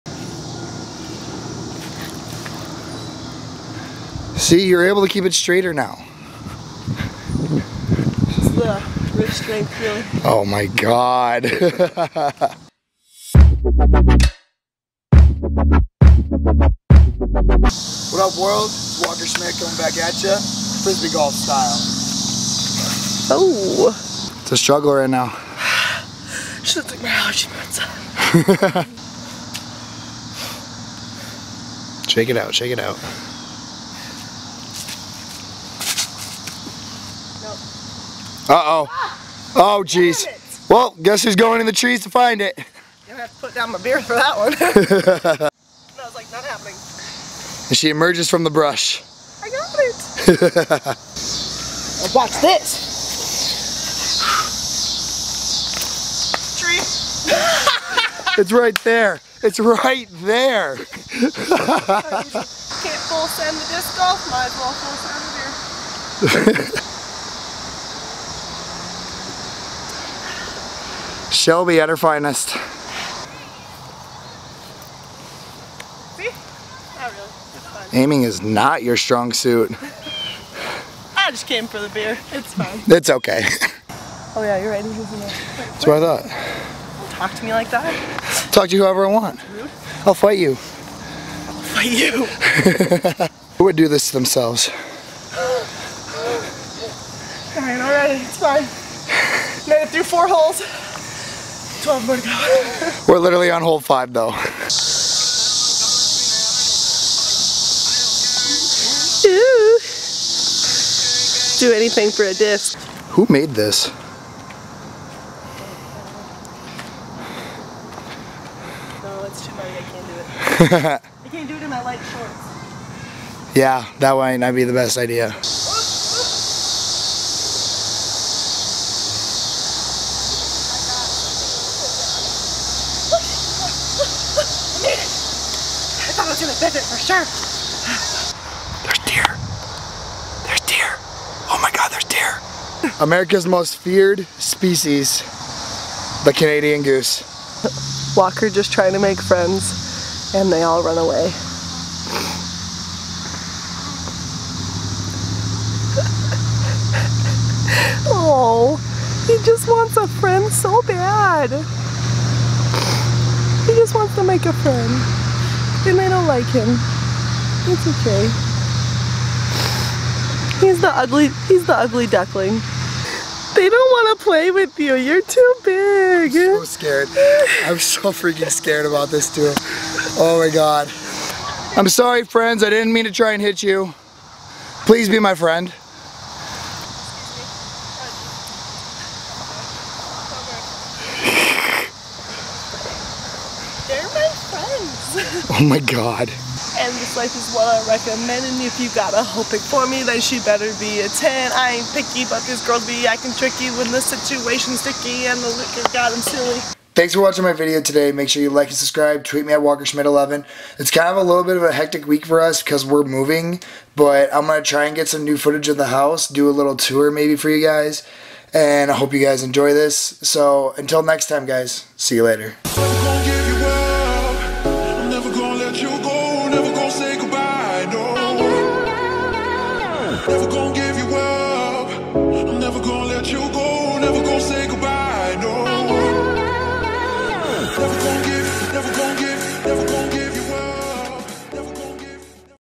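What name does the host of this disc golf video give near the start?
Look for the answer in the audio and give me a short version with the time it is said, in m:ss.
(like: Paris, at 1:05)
Walker Schmidt, at 0:19.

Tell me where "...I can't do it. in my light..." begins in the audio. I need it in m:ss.
2:00.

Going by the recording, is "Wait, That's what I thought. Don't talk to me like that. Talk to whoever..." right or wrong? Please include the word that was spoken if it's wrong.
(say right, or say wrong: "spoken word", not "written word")
right.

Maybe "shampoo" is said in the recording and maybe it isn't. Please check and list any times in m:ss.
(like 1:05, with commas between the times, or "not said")
not said.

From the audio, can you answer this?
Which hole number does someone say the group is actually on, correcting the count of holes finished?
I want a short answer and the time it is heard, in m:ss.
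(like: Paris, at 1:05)
5, at 1:43.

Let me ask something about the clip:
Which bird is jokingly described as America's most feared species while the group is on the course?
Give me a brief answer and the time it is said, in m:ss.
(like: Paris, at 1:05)
Canadian goose, at 2:26.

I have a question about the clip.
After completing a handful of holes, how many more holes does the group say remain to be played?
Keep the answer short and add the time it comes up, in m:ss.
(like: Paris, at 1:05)
12, at 1:41.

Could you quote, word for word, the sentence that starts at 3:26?
Thanks for watching my video today.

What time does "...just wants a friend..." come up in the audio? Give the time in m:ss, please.
2:39.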